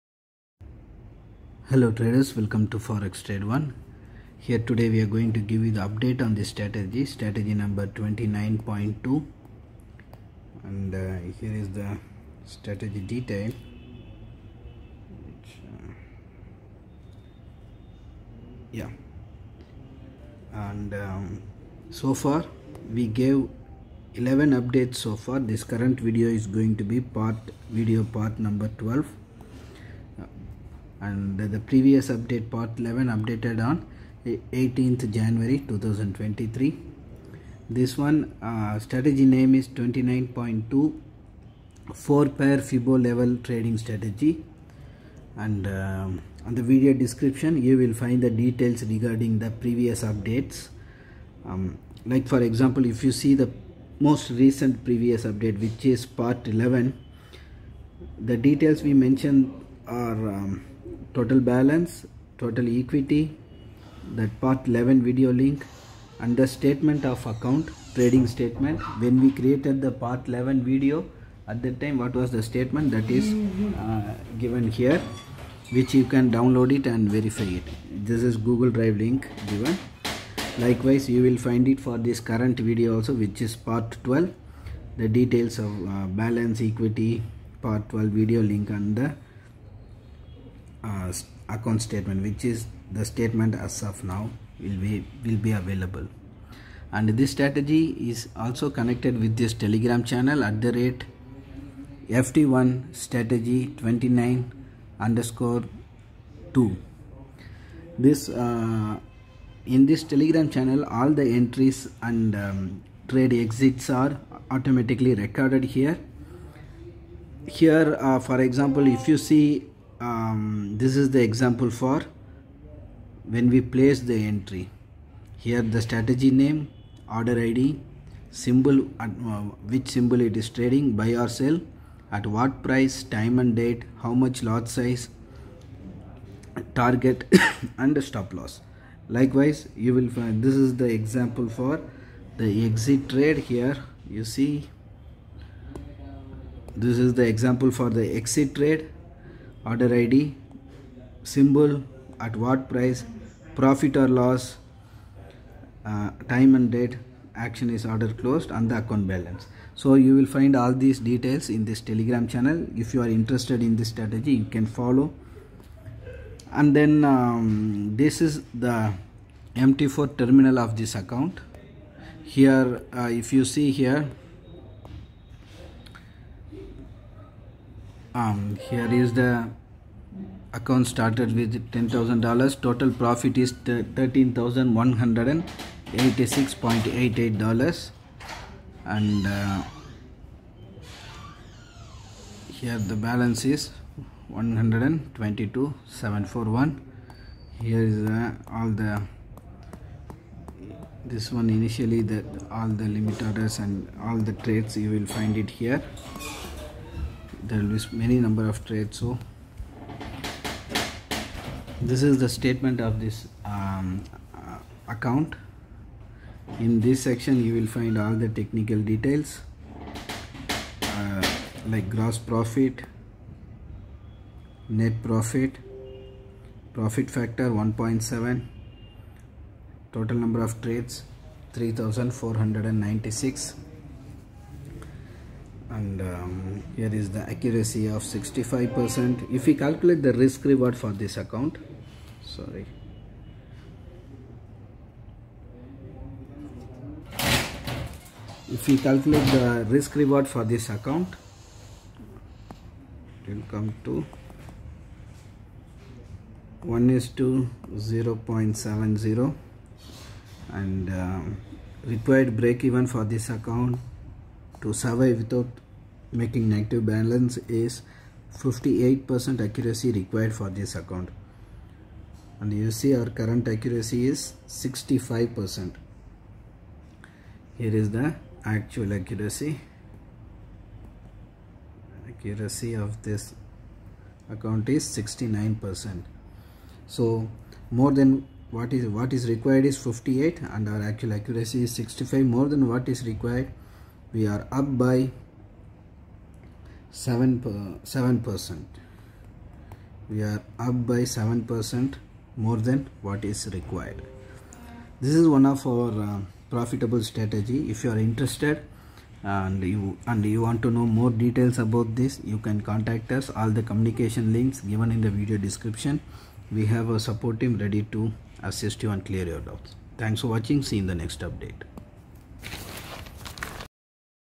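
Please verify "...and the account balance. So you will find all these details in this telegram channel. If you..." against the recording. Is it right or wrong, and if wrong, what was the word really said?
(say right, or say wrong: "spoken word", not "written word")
right.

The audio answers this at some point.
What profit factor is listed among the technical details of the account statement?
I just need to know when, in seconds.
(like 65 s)
227 s.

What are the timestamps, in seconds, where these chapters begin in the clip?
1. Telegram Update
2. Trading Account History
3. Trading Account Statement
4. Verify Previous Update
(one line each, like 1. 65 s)
1. 95 s
2. 170 s
3. 210 s
4. 10 s.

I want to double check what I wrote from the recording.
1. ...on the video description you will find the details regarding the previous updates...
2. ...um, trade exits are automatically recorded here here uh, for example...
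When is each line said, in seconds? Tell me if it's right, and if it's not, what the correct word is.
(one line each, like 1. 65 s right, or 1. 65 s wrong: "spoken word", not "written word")
1. 46 s right
2. 112 s right.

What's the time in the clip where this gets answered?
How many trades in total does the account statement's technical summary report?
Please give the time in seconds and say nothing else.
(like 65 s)
231 s.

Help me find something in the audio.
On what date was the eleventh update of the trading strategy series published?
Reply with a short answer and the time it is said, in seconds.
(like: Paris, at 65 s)
18th January 2023, at 34 s.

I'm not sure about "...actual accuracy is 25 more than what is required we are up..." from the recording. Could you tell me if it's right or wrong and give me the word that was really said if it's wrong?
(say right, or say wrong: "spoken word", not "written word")
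wrong: "65", not "25".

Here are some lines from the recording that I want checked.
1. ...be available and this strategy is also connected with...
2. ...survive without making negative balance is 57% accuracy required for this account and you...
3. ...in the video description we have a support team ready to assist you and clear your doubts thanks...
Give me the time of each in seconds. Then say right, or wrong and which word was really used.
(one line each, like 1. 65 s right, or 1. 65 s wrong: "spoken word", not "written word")
1. 95 s right
2. 264 s wrong: "58", not "57"
3. 314 s right.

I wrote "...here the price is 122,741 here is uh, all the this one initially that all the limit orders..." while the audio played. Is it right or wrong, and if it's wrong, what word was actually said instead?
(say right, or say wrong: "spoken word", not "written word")
wrong: "balance", not "price".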